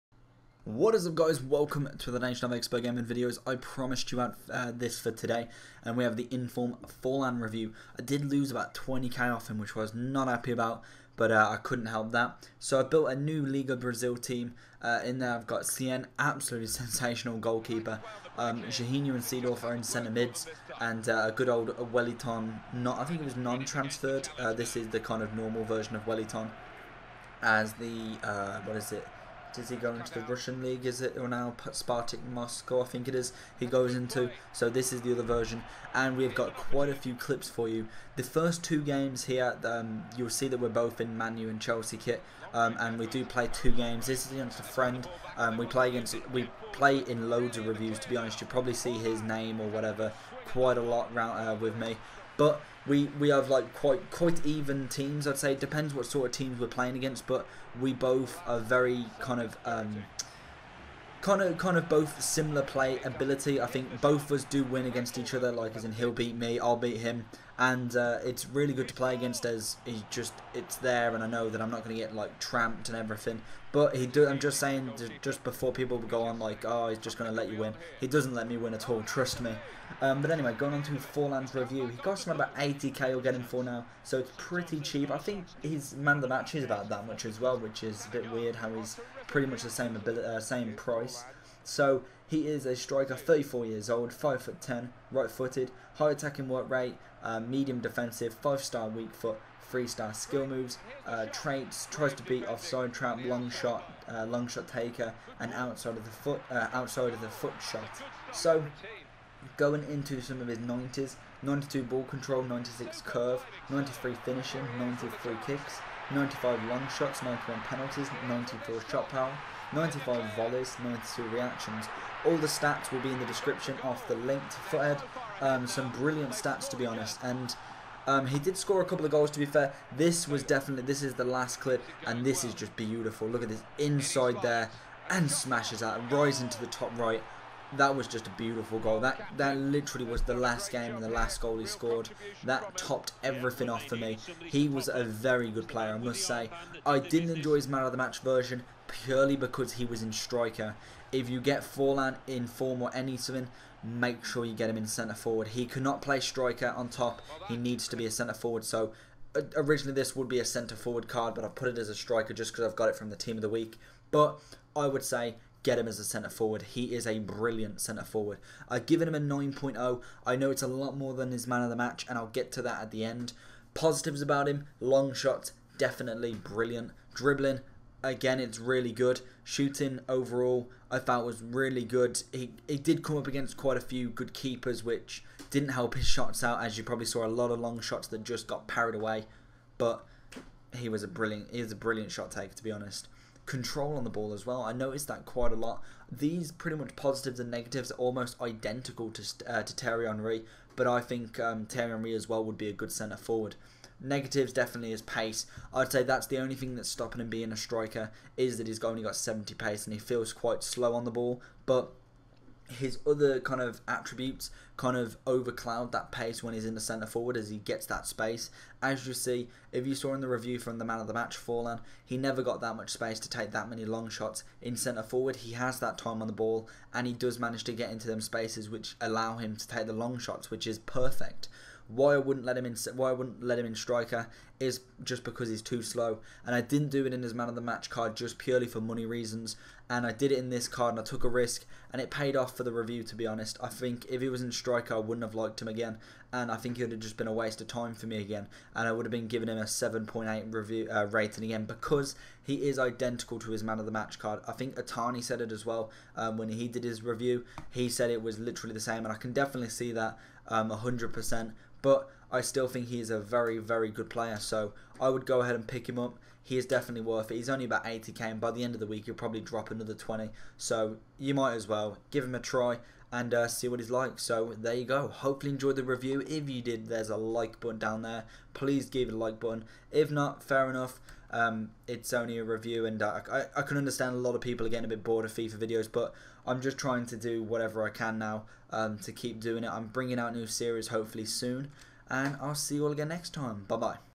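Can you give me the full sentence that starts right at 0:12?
So I built a new Liga Brazil team.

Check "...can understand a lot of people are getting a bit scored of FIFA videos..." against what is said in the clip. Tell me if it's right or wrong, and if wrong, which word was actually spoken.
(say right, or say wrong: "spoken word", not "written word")
wrong: "bored", not "scored".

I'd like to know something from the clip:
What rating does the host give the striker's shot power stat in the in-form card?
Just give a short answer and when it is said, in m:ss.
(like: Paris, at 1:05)
94, at 1:58.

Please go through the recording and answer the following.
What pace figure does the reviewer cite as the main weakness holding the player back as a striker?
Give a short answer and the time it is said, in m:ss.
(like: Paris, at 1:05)
70, at 3:29.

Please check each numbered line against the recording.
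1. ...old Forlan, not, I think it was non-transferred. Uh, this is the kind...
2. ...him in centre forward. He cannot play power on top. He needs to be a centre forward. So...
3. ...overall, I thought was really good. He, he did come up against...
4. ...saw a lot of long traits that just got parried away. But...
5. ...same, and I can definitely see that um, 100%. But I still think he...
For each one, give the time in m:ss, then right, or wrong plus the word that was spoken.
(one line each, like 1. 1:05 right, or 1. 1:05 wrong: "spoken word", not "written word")
1. 0:21 wrong: "Wellington", not "Forlan"
2. 2:34 wrong: "striker", not "power"
3. 3:00 right
4. 3:07 wrong: "shots", not "traits"
5. 4:18 right.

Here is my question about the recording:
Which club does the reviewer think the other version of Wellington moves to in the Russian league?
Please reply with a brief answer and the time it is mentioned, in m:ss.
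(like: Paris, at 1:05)
Spartak Moscow, at 0:31.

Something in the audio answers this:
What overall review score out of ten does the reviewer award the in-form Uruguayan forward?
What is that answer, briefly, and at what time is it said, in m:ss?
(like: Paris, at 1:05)
9.0, at 2:49.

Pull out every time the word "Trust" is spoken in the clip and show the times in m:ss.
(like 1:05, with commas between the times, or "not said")
1:19.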